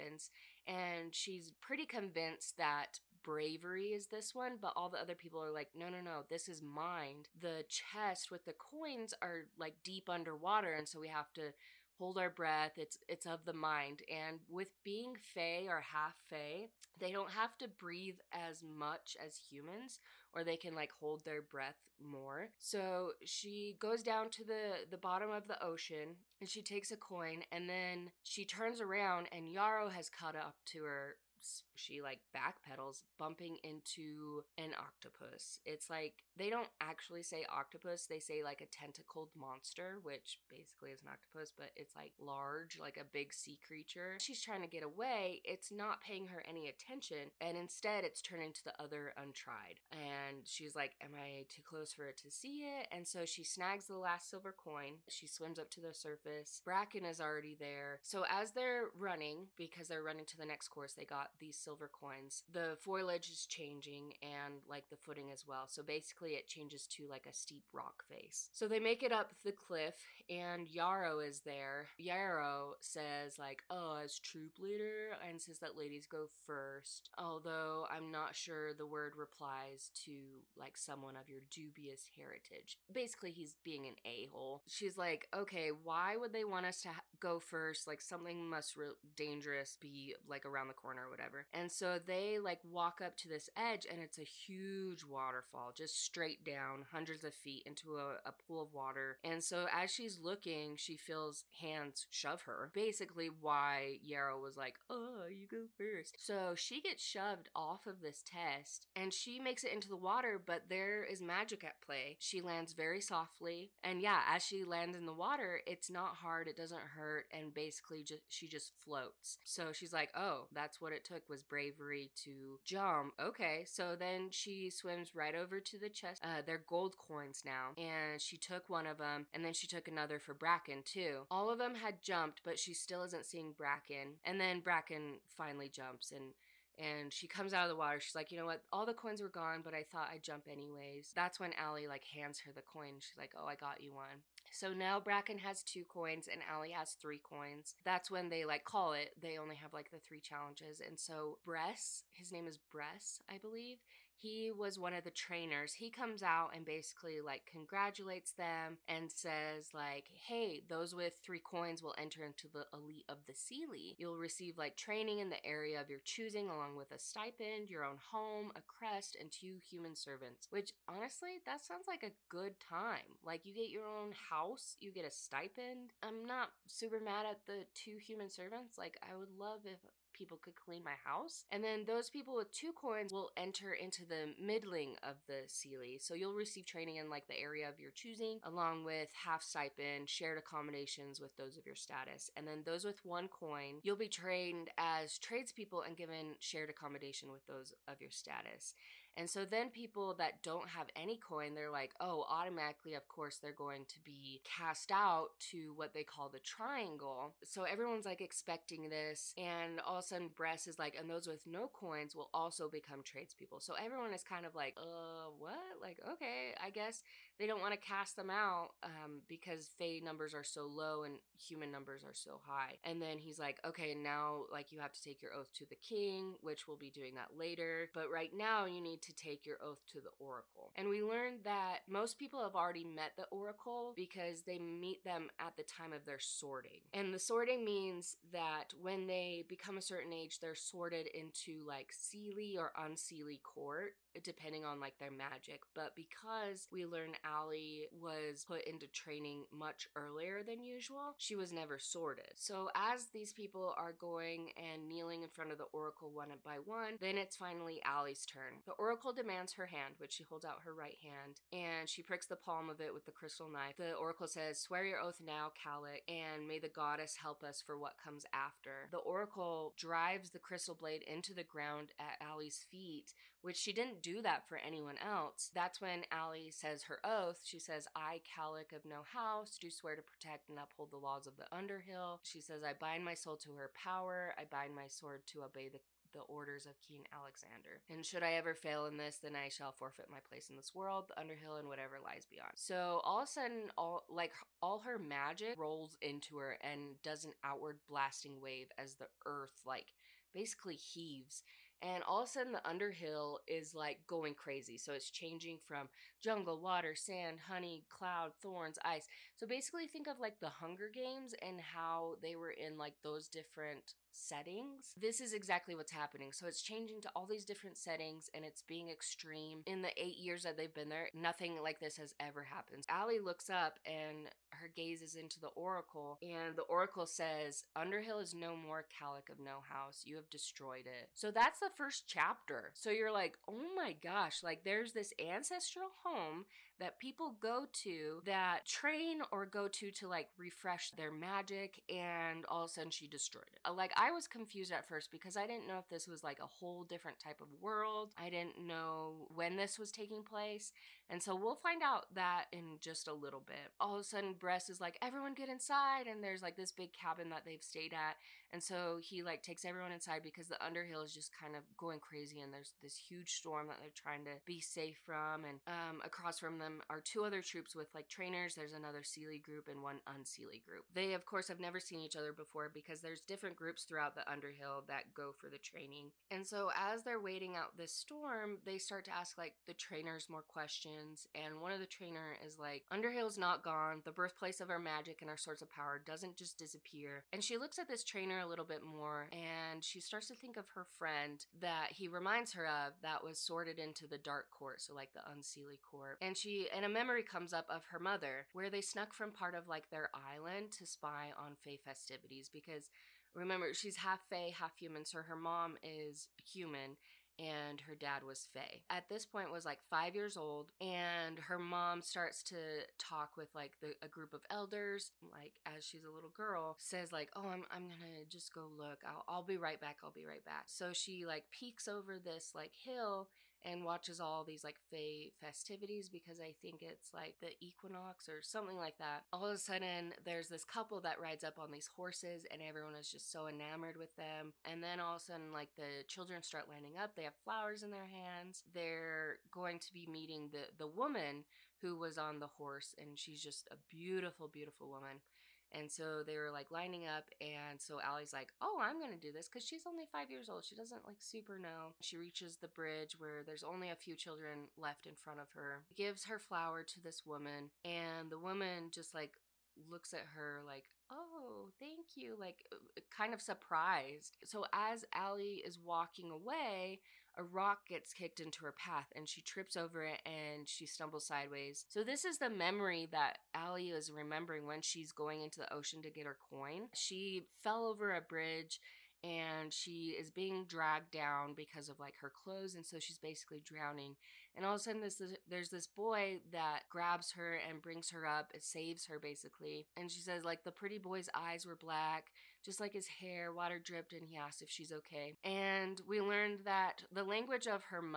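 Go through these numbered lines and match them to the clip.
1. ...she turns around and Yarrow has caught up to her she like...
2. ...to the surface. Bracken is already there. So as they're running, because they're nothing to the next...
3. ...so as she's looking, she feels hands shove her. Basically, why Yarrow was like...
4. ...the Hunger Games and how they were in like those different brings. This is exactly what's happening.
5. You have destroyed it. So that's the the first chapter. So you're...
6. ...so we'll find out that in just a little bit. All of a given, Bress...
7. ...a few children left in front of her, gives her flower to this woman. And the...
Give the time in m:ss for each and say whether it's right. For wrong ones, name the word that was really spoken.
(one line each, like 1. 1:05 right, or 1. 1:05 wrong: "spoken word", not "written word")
1. 0:28 right
2. 0:55 wrong: "running", not "nothing"
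3. 1:39 right
4. 5:10 wrong: "settings", not "brings"
5. 5:30 right
6. 5:51 wrong: "sudden", not "given"
7. 7:33 right.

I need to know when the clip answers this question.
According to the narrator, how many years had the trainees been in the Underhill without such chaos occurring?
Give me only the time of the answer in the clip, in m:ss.
5:20.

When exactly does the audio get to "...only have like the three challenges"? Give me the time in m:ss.
2:29.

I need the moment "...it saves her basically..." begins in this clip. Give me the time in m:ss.
8:08.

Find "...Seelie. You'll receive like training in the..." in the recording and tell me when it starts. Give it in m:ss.
2:43.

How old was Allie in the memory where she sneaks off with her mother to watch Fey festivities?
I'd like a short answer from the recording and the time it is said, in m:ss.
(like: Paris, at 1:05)
5, at 6:49.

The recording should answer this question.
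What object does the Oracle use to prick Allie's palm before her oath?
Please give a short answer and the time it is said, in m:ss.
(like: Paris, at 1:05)
Crystal knife, at 4:23.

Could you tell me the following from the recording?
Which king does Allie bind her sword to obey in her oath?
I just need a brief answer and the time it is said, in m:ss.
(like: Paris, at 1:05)
King Alexander, at 4:46.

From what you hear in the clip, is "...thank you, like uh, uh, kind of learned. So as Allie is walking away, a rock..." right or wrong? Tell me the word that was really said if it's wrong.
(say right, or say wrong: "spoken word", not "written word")
wrong: "surprised", not "learned".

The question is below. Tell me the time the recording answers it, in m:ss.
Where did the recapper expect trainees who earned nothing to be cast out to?
3:26.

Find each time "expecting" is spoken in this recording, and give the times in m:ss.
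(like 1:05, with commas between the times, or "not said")
3:28.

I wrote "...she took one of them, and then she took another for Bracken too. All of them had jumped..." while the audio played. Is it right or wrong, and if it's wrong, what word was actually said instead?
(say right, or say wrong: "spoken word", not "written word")
right.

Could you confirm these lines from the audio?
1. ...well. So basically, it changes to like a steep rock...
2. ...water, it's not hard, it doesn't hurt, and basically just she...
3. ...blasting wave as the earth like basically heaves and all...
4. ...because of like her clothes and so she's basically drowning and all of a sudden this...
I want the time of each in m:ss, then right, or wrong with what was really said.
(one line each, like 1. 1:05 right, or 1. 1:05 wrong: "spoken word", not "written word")
1. 1:05 right
2. 1:55 right
3. 4:57 right
4. 8:01 right.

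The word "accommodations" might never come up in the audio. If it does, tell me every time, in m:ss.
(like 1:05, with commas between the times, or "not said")
3:10, 3:16.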